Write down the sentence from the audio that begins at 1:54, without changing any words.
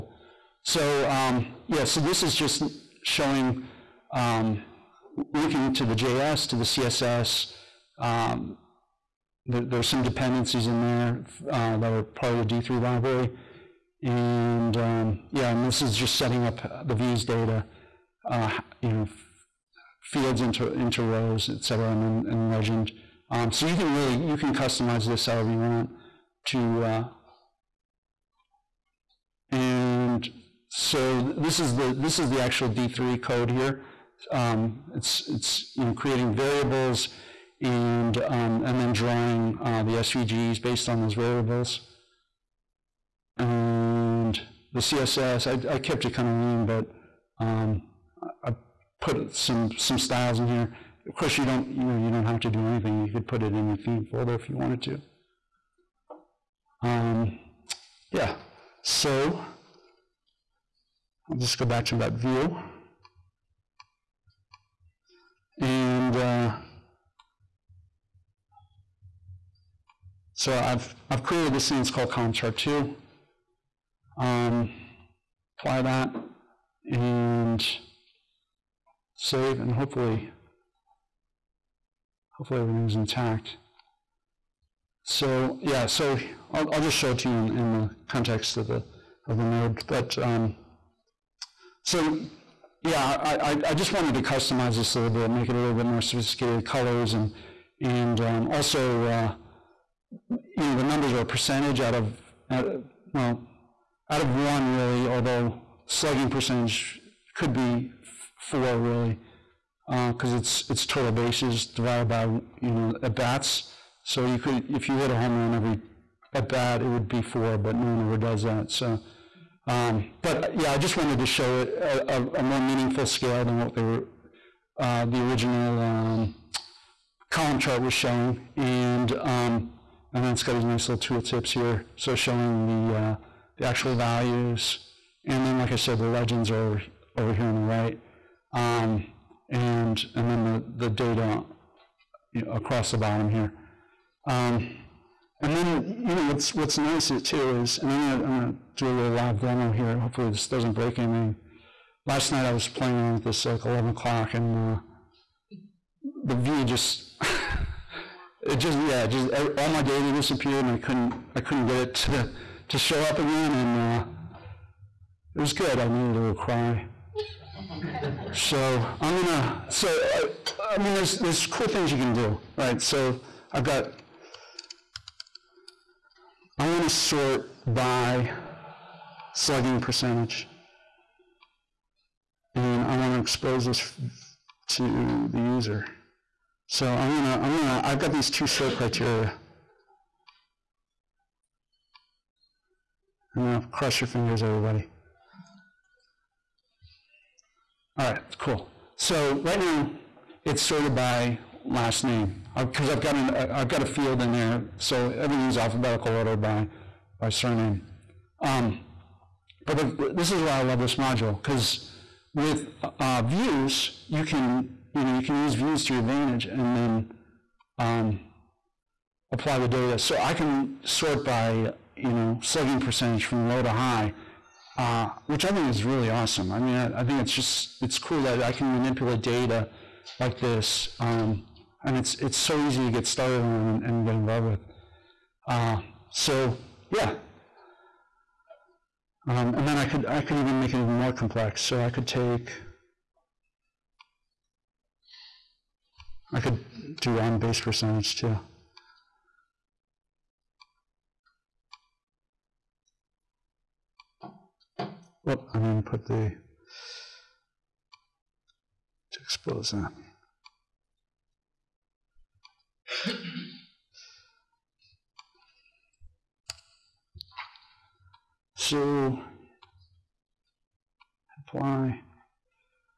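So you could if you hit a home run every at that, it would be four, but no one ever does that.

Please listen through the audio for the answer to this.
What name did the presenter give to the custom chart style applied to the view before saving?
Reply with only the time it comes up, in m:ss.
1:12.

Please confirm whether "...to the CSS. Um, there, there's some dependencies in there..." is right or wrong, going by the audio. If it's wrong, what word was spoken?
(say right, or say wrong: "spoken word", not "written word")
right.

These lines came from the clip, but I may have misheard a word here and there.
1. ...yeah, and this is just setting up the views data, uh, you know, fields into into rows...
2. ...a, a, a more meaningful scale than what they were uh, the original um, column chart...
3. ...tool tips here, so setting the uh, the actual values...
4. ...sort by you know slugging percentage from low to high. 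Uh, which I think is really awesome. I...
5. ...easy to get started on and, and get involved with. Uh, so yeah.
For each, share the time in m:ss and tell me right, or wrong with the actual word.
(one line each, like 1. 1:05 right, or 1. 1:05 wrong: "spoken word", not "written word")
1. 0:15 right
2. 2:01 right
3. 2:10 wrong: "showing", not "setting"
4. 3:40 right
5. 3:52 right.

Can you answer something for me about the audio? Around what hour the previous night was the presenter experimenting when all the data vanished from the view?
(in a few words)
11 o'clock.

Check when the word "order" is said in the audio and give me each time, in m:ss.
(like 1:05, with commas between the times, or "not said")
3:26.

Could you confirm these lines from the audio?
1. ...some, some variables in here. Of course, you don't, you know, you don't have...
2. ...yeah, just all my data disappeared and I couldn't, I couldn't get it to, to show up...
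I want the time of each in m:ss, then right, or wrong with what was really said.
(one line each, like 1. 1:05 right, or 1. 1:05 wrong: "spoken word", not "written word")
1. 0:49 wrong: "styles", not "variables"
2. 2:38 right.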